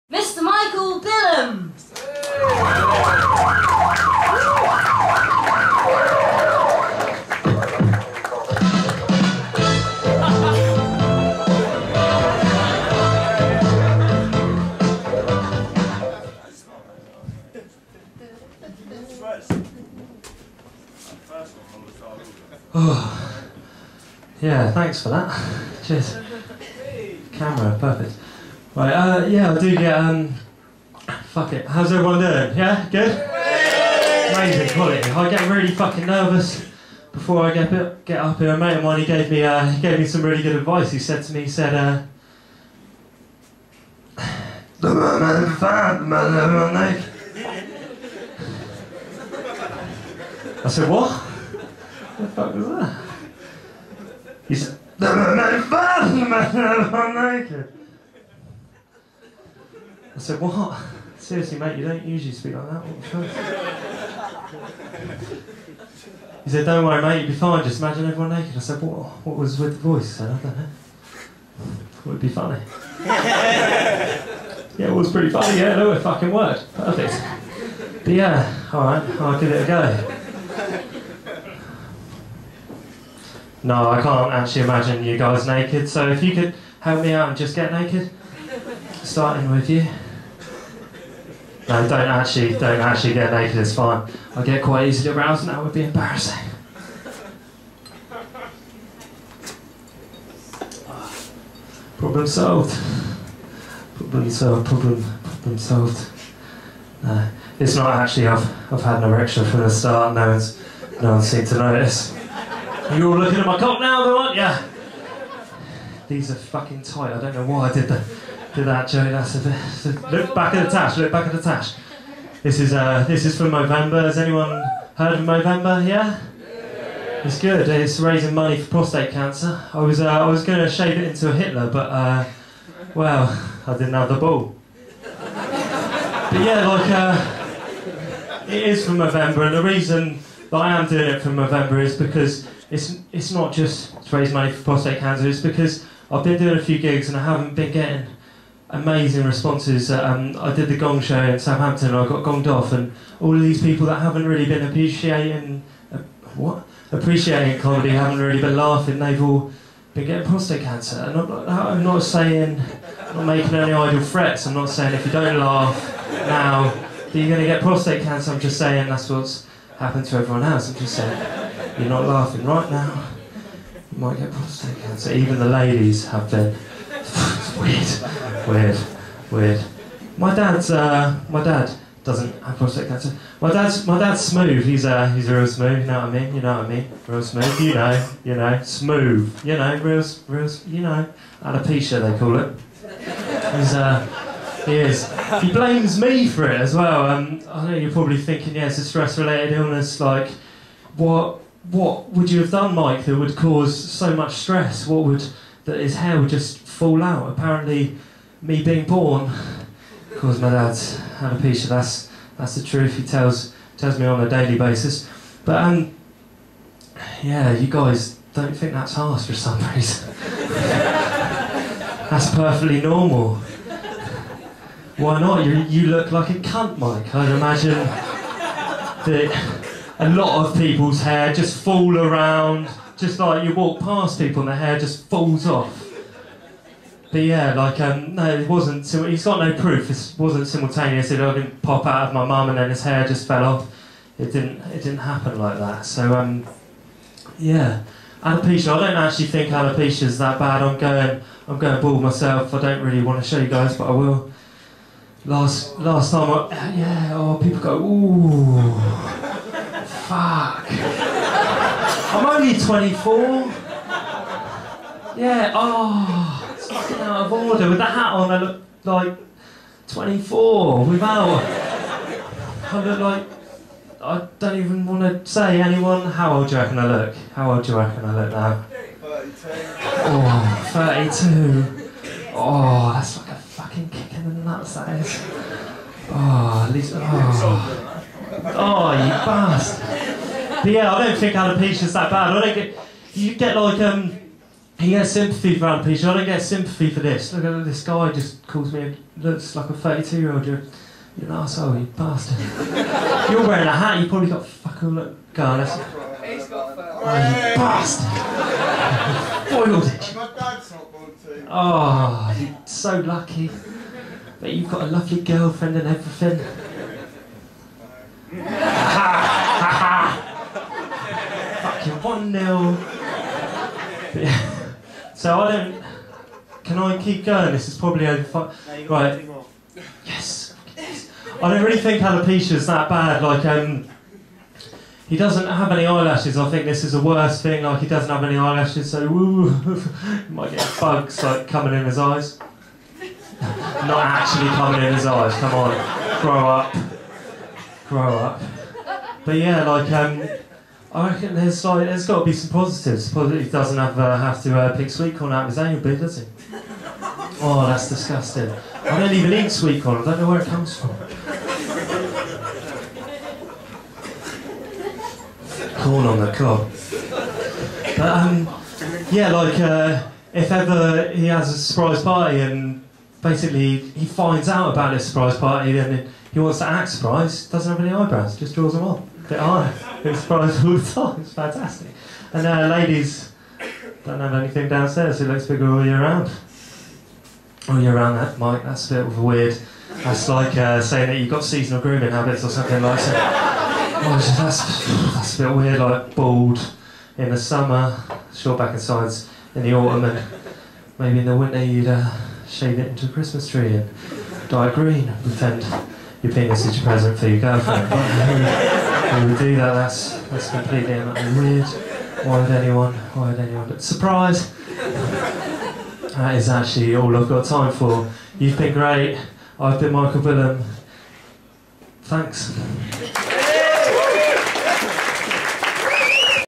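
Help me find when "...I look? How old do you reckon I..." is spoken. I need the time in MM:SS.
04:36.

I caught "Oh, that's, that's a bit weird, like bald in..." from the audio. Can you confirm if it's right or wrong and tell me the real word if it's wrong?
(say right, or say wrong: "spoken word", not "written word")
right.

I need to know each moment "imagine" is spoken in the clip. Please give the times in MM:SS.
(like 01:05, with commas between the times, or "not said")
01:07, 01:24, 03:47.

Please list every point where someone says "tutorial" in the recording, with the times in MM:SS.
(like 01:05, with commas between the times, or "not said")
not said.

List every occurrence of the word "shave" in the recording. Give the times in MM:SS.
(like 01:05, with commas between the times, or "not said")
02:10, 06:42.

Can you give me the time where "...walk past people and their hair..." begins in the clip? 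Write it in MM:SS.
03:53.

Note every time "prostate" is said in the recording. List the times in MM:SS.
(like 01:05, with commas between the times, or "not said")
02:08, 02:24, 02:40, 02:47, 02:54, 03:02.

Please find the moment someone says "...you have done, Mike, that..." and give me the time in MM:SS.
03:22.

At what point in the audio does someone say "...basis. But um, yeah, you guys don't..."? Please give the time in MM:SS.
03:34.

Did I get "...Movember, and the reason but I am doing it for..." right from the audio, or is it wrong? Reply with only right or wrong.
right.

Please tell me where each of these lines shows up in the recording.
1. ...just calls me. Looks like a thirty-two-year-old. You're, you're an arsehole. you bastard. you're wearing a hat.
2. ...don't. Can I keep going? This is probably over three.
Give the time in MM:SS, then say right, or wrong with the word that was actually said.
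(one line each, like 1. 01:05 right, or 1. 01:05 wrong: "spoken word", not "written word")
1. 04:58 right
2. 05:25 wrong: "five", not "three".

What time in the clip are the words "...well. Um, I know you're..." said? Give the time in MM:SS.
03:16.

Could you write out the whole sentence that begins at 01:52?
You are all looking at my cock now though, aren't you?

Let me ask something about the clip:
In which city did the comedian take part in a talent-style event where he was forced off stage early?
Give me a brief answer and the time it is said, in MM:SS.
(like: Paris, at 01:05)
Southampton, at 02:31.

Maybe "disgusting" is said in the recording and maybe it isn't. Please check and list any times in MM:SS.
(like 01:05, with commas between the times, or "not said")
05:57.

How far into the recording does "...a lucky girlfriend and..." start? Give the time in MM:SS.
05:14.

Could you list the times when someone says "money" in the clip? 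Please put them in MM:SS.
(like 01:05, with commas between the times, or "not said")
02:08, 02:24.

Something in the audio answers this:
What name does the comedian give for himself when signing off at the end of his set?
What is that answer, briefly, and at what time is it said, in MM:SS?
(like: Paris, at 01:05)
Michael Bilham, at 06:59.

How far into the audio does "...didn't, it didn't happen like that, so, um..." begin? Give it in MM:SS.
04:04.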